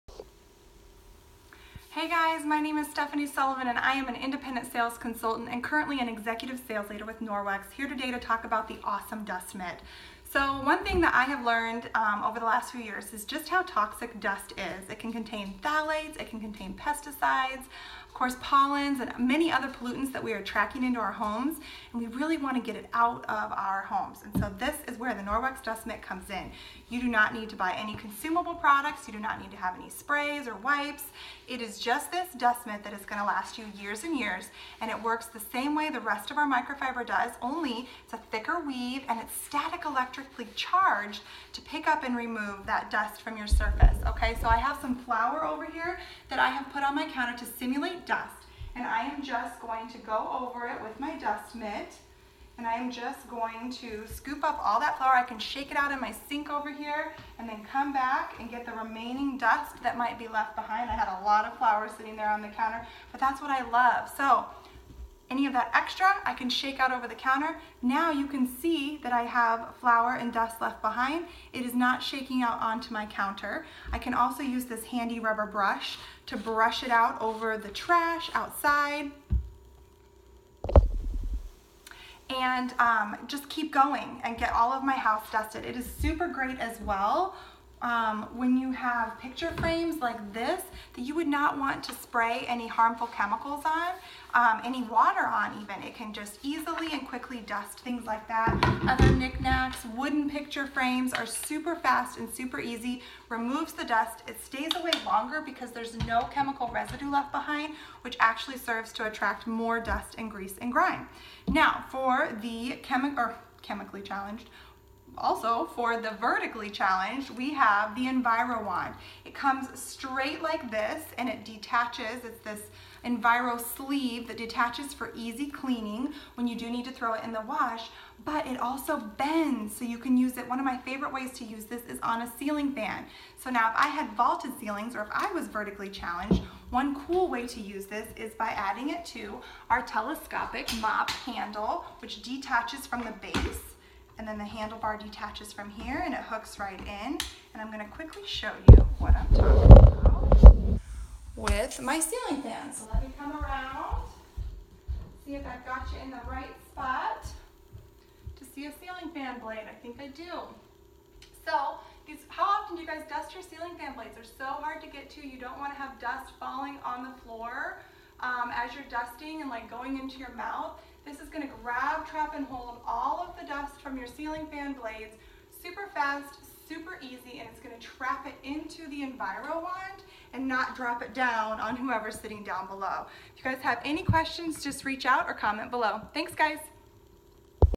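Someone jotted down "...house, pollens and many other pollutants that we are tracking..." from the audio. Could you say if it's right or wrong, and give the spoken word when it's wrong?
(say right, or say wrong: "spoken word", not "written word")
wrong: "course", not "house".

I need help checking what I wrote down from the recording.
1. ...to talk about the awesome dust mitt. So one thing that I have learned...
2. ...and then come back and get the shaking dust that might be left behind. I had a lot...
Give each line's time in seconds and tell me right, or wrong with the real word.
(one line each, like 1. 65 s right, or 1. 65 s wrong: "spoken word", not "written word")
1. 8 s right
2. 57 s wrong: "remaining", not "shaking".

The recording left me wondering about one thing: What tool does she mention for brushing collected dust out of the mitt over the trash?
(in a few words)
Rubber brush.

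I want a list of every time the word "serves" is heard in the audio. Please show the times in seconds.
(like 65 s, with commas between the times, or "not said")
108 s.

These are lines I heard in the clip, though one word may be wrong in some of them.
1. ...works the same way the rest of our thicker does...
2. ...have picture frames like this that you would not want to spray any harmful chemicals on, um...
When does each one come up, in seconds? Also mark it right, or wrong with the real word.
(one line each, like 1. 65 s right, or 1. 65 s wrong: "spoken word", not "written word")
1. 35 s wrong: "microfiber", not "thicker"
2. 88 s right.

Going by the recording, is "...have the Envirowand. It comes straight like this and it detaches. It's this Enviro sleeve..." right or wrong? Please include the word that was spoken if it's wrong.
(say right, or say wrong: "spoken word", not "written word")
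right.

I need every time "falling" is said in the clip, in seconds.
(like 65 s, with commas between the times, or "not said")
166 s.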